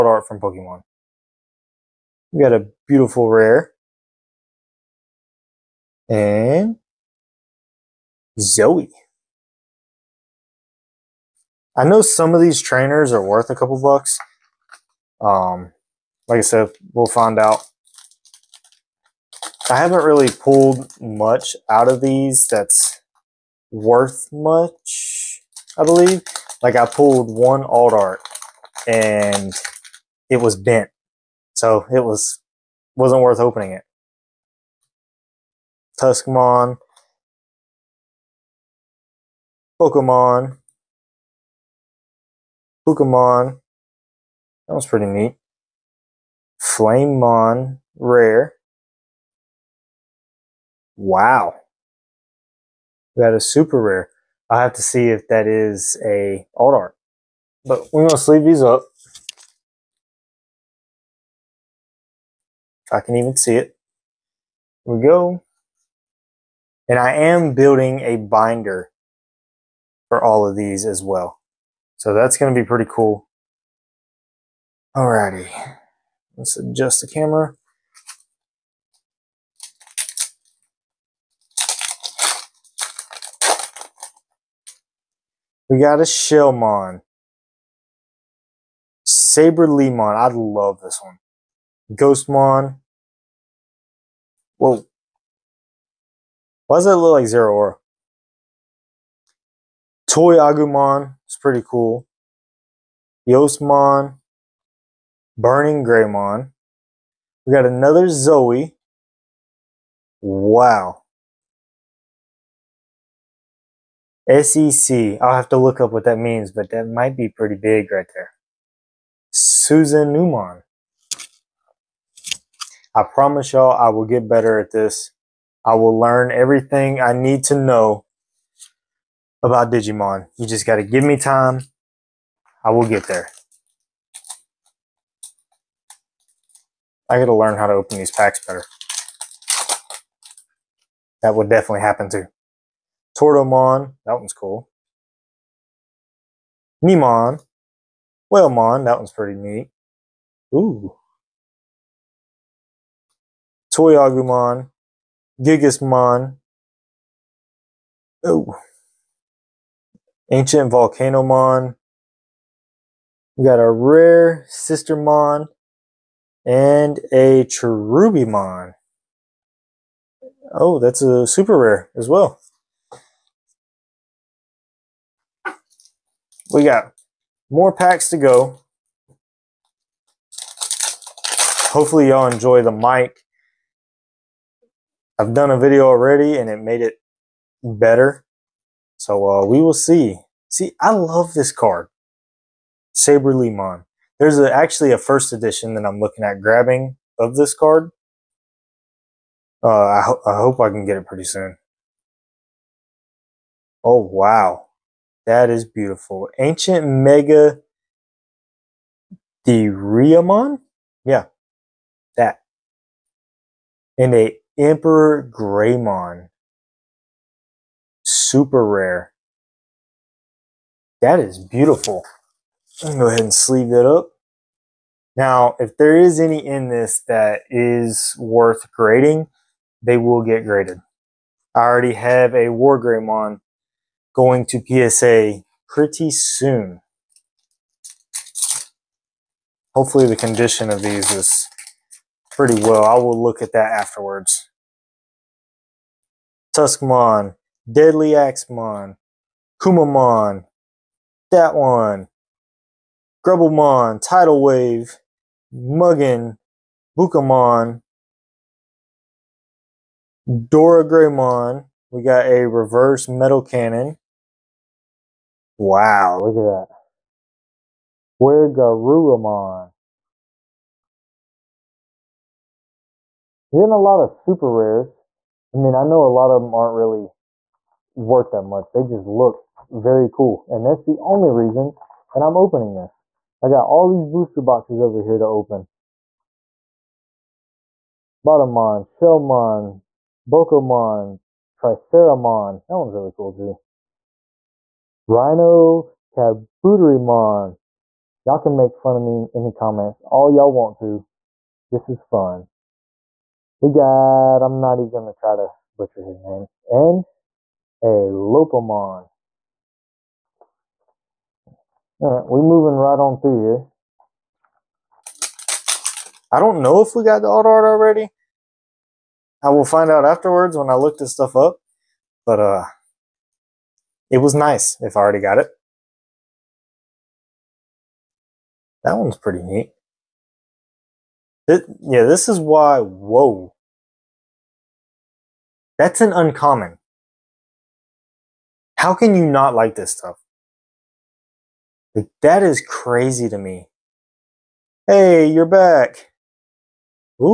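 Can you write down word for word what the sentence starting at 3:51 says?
I already have a War Greymon going to PSA pretty soon.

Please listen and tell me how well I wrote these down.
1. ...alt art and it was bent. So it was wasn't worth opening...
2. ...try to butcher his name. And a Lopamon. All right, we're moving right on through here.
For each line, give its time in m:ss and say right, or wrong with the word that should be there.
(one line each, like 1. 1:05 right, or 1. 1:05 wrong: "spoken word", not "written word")
1. 0:27 right
2. 5:05 right.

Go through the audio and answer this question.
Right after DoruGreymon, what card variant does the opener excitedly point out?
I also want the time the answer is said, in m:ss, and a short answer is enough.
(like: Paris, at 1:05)
reverse metal cannon, at 4:22.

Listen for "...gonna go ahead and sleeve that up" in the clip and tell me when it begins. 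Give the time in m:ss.
3:42.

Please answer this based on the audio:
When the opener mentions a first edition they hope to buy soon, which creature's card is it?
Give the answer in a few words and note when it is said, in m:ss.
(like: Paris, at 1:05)
Saber Limon, at 3:12.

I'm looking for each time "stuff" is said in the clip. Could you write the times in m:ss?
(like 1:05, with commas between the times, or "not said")
5:21, 5:39.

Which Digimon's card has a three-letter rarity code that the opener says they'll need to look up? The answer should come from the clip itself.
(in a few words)
Susanoomon.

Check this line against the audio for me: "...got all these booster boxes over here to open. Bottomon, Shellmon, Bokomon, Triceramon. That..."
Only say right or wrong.
right.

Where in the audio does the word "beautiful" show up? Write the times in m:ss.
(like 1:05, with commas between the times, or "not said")
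0:02, 3:25, 3:41.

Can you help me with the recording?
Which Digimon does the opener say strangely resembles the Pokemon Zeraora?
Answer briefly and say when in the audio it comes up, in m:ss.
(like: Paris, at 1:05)
Ghostmon, at 1:31.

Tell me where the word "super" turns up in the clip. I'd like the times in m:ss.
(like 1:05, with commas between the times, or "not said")
0:53, 2:51, 3:38, 4:34.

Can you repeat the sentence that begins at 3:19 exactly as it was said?
Uh, I, ho I hope I can get it pretty soon.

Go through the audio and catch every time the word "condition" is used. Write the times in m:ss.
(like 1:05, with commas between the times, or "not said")
4:00.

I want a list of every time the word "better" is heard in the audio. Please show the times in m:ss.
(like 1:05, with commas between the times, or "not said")
2:04, 2:18, 3:07.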